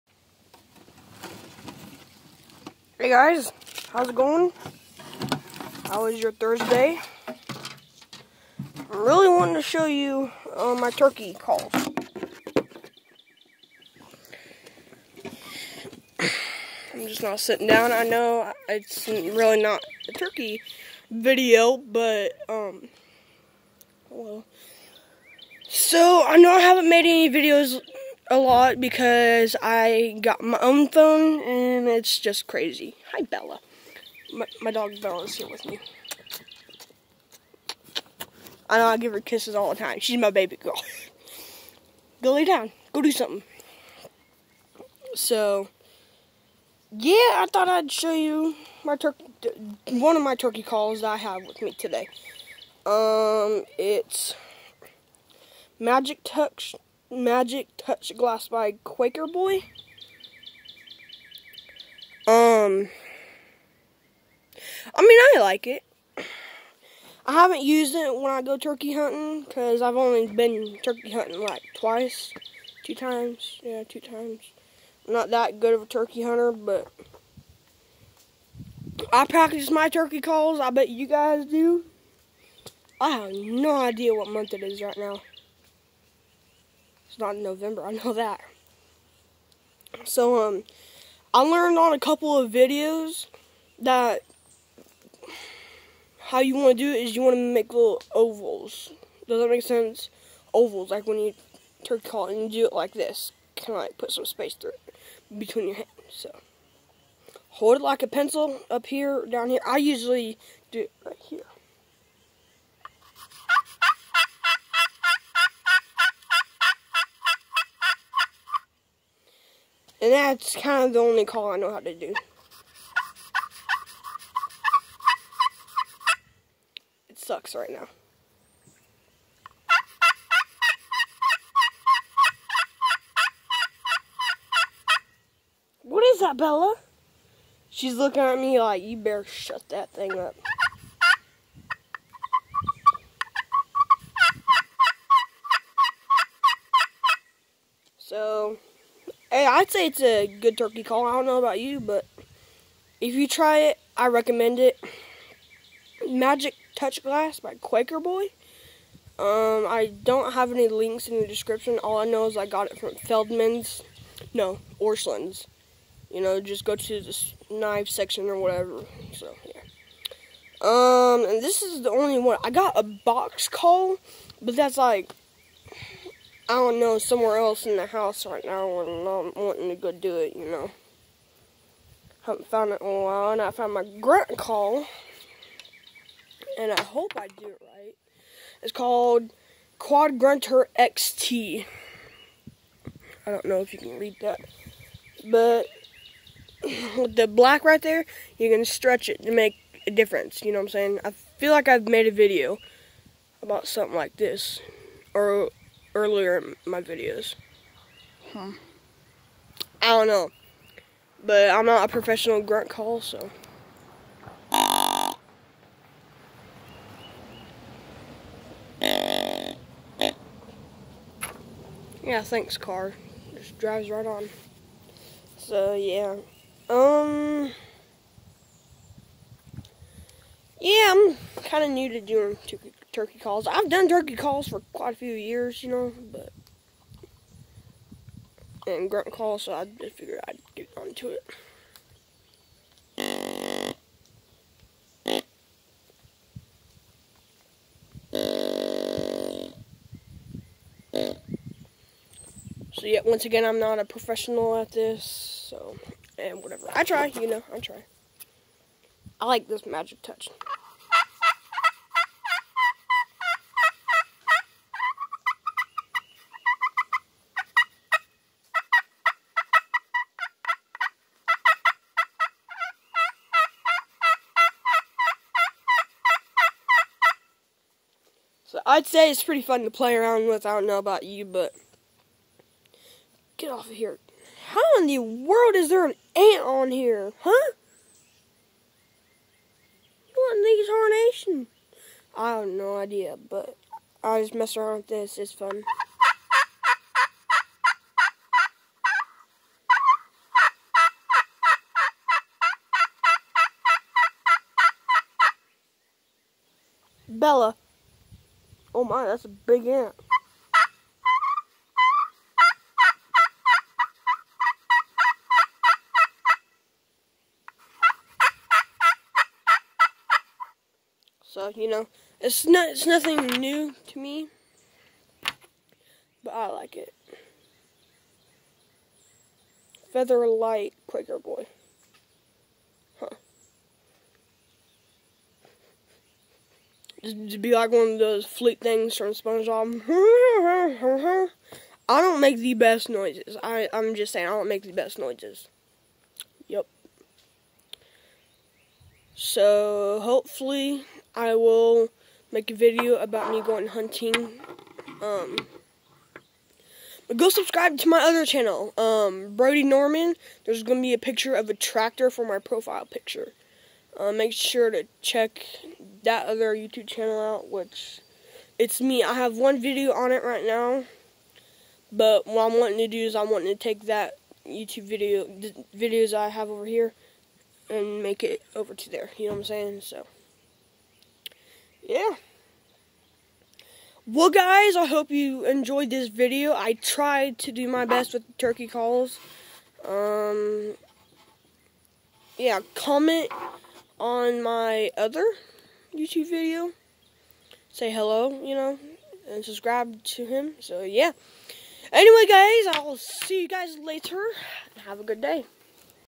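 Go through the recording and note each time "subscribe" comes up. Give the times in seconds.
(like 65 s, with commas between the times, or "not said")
357 s, 399 s.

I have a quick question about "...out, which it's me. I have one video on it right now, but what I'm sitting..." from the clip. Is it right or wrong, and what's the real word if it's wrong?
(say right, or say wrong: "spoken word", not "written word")
wrong: "wanting", not "sitting".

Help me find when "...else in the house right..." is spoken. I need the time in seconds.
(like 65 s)
177 s.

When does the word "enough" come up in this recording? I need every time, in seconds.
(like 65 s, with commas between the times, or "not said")
not said.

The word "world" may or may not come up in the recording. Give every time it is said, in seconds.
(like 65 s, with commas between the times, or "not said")
284 s.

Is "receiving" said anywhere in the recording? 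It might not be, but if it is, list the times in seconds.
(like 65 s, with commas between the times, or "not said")
not said.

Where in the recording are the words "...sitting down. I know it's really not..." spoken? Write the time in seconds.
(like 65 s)
17 s.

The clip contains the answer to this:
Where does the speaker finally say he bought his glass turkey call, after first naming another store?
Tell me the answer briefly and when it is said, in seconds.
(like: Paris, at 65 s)
Orscheln's, at 164 s.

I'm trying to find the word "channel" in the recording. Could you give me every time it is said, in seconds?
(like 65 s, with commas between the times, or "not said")
358 s, 366 s.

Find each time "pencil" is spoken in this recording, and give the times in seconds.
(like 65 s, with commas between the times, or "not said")
108 s.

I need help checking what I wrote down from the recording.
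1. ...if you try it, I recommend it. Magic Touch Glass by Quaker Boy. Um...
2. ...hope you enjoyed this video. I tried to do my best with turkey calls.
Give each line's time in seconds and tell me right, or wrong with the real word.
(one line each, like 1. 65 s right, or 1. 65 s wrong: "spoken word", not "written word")
1. 152 s right
2. 384 s right.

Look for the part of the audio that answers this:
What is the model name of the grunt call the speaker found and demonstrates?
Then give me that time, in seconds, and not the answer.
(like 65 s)
189 s.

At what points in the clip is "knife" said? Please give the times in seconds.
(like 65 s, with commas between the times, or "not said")
167 s.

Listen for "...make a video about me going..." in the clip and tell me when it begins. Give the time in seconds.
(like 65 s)
352 s.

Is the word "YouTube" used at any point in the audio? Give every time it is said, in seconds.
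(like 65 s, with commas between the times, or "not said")
366 s, 374 s, 395 s.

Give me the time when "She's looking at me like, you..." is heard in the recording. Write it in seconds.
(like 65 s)
137 s.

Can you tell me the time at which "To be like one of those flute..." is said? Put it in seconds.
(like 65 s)
337 s.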